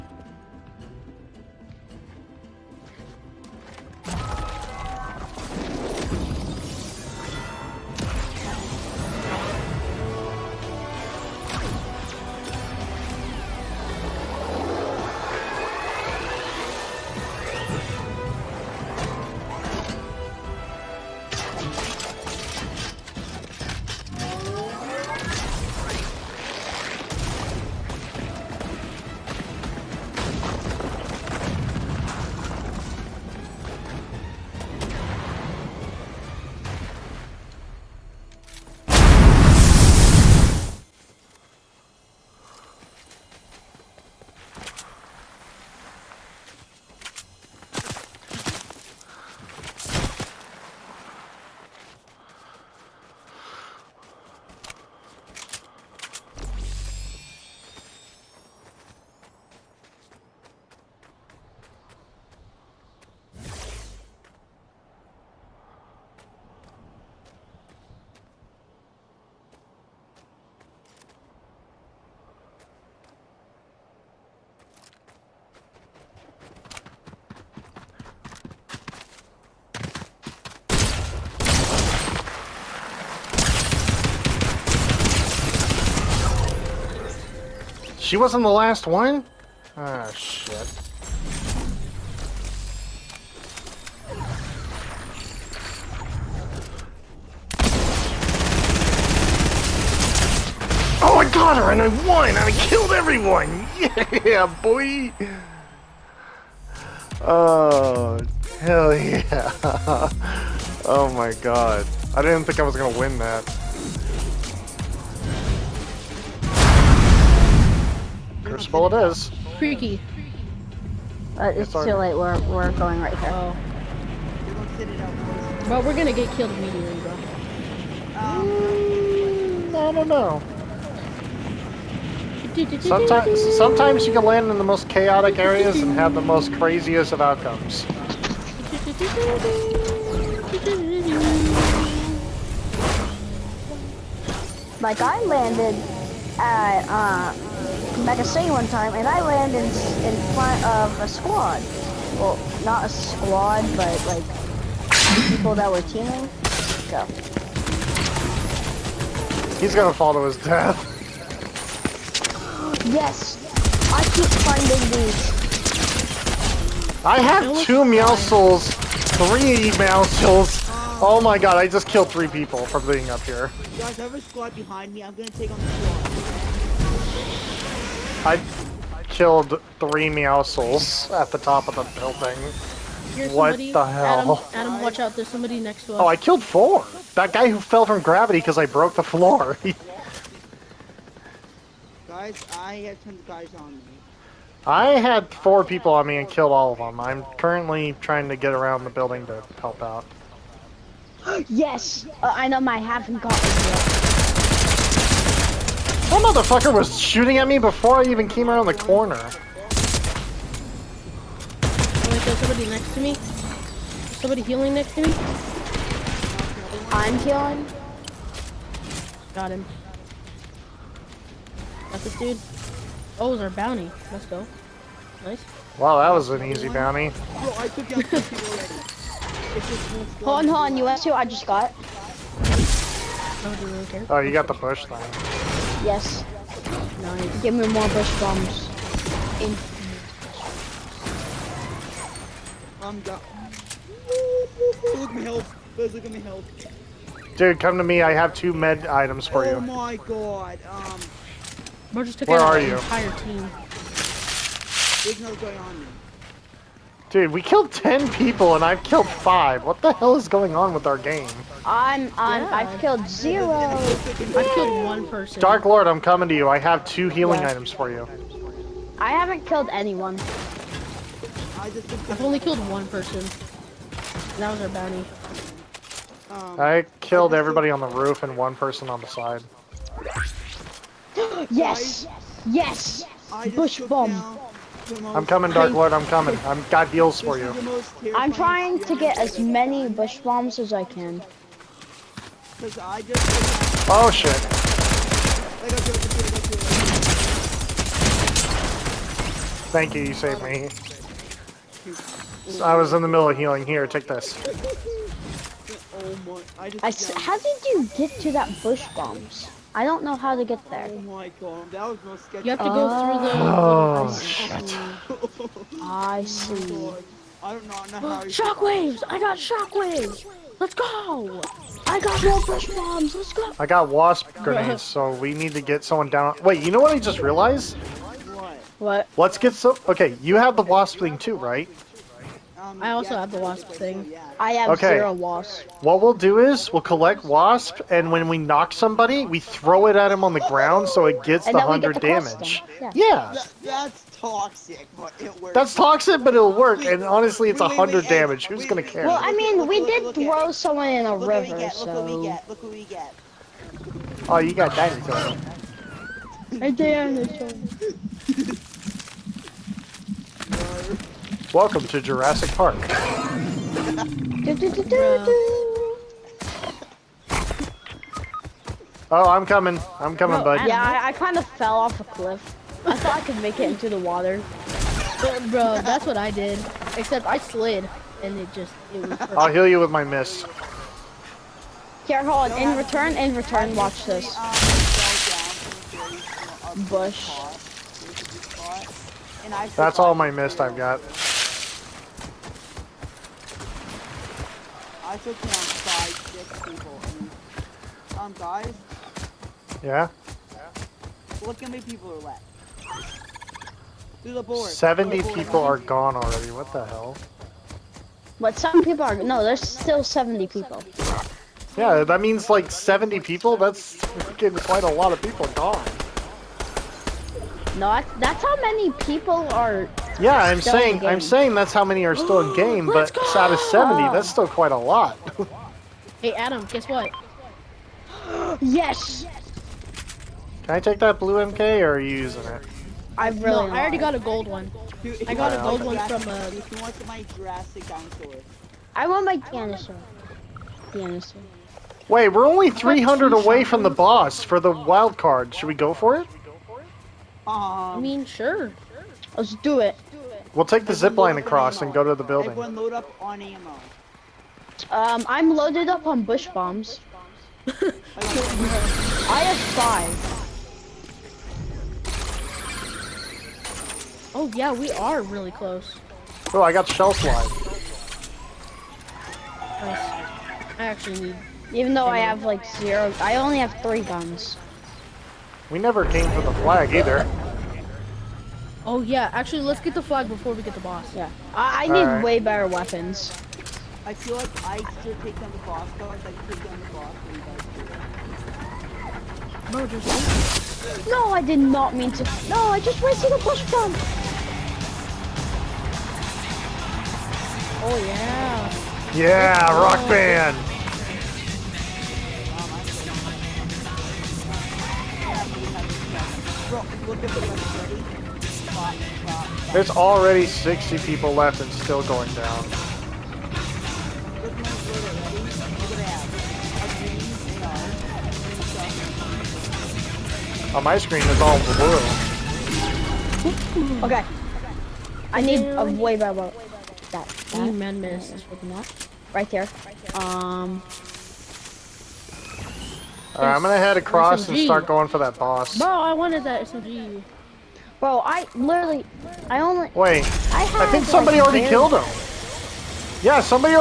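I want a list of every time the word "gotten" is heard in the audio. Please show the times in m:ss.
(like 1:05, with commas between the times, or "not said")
3:23.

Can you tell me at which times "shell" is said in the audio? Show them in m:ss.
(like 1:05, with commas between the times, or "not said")
7:46.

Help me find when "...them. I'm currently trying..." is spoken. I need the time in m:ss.
3:16.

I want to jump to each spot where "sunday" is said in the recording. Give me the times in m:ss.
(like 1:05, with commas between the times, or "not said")
not said.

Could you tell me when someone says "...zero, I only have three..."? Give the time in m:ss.
7:52.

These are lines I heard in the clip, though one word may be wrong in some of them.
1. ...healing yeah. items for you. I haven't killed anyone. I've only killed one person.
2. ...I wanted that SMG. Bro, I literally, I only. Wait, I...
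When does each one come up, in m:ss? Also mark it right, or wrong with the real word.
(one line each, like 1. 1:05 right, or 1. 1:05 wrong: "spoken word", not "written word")
1. 4:27 right
2. 8:55 right.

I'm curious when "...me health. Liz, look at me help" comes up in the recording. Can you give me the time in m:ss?
4:05.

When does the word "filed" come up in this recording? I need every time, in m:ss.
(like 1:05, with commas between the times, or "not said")
not said.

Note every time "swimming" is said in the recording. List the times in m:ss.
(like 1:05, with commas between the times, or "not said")
not said.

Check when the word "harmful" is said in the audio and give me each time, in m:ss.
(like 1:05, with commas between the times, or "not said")
not said.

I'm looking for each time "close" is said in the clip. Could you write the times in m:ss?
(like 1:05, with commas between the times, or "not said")
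7:45.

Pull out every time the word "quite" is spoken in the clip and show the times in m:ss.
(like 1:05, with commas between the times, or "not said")
6:54, 7:04.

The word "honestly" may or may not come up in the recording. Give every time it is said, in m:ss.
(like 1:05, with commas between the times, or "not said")
5:47.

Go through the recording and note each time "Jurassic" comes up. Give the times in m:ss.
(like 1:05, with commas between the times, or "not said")
6:01, 7:17.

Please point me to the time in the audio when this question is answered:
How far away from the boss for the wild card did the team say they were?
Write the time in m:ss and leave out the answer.
7:22.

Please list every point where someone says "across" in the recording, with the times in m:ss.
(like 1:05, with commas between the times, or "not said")
7:31, 8:53.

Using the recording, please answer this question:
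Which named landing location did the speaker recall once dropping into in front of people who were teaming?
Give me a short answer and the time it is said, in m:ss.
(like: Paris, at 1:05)
Mega C, at 2:28.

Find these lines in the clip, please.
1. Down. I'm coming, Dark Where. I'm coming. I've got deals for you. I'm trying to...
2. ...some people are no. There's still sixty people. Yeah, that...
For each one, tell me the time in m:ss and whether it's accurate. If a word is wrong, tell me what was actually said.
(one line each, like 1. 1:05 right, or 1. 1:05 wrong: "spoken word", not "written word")
1. 4:44 wrong: "Lord", not "Where"
2. 6:48 wrong: "seventy", not "sixty".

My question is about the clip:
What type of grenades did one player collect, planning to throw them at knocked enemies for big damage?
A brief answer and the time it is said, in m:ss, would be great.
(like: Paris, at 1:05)
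wasp grenades, at 5:23.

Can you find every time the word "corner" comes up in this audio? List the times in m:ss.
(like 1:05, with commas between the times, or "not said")
3:28.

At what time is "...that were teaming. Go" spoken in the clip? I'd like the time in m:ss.
2:35.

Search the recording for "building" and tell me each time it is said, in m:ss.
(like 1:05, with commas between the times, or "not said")
3:01, 3:18, 7:32.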